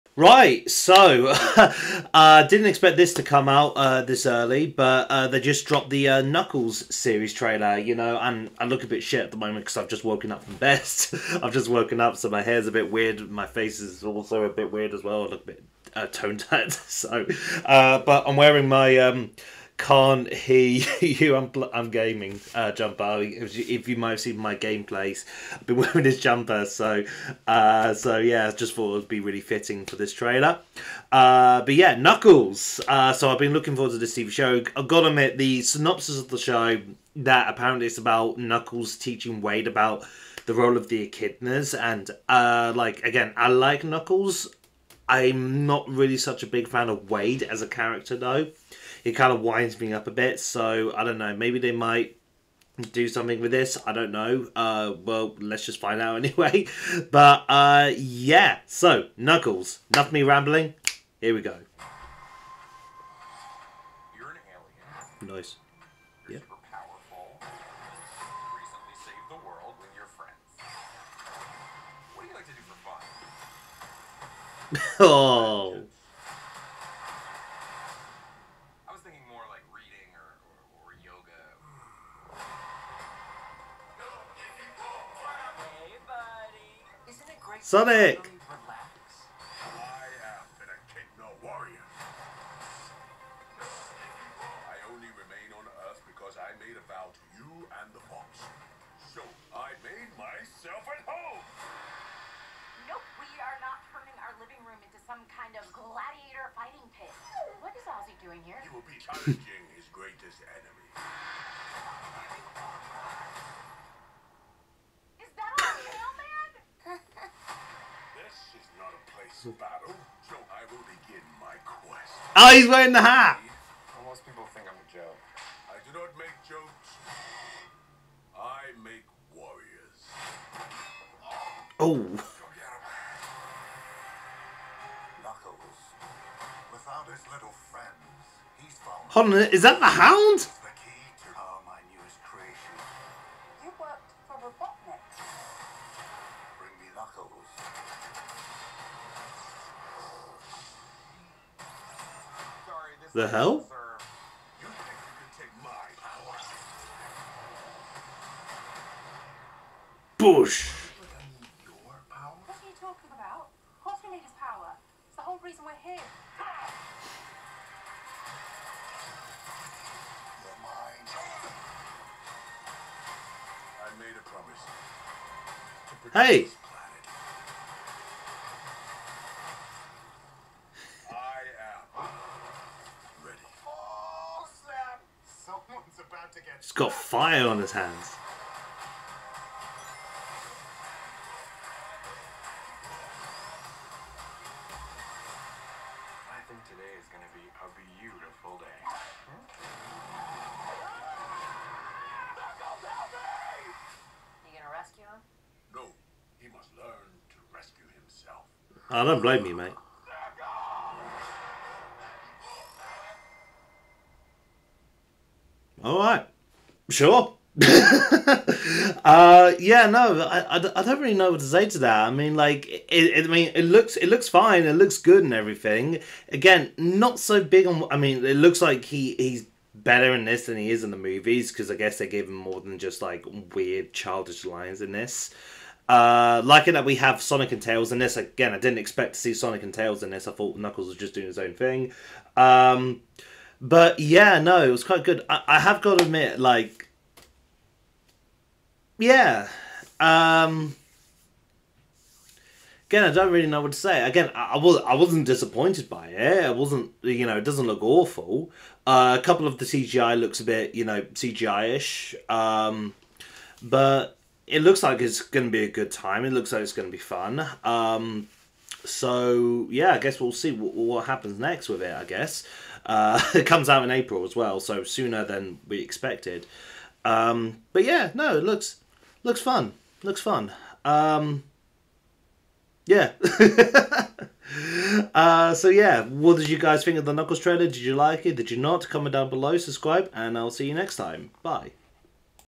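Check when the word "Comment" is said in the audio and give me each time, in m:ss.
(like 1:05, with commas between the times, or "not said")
4:48.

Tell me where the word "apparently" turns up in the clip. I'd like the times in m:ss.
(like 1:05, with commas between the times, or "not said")
0:37.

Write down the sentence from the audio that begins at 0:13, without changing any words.
My face is also a bit weird as well.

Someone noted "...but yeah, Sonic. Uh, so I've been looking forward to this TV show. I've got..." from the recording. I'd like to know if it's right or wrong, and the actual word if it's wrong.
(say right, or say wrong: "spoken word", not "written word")
wrong: "Knuckles", not "Sonic".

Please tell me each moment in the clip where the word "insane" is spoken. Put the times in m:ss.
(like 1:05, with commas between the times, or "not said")
not said.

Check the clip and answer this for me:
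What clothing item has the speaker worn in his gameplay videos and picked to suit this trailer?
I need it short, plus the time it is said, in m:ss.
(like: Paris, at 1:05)
jumper, at 0:26.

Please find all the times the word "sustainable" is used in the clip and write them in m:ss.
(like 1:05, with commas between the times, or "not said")
not said.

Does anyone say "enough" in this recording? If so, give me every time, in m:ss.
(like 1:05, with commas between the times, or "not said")
0:59.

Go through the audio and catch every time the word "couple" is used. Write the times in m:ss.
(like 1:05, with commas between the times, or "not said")
4:19.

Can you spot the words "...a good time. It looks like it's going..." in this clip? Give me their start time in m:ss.
4:25.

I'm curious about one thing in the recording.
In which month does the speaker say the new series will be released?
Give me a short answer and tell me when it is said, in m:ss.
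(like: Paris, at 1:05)
April, at 4:33.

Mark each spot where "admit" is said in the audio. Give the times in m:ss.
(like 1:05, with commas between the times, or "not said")
0:35, 4:06.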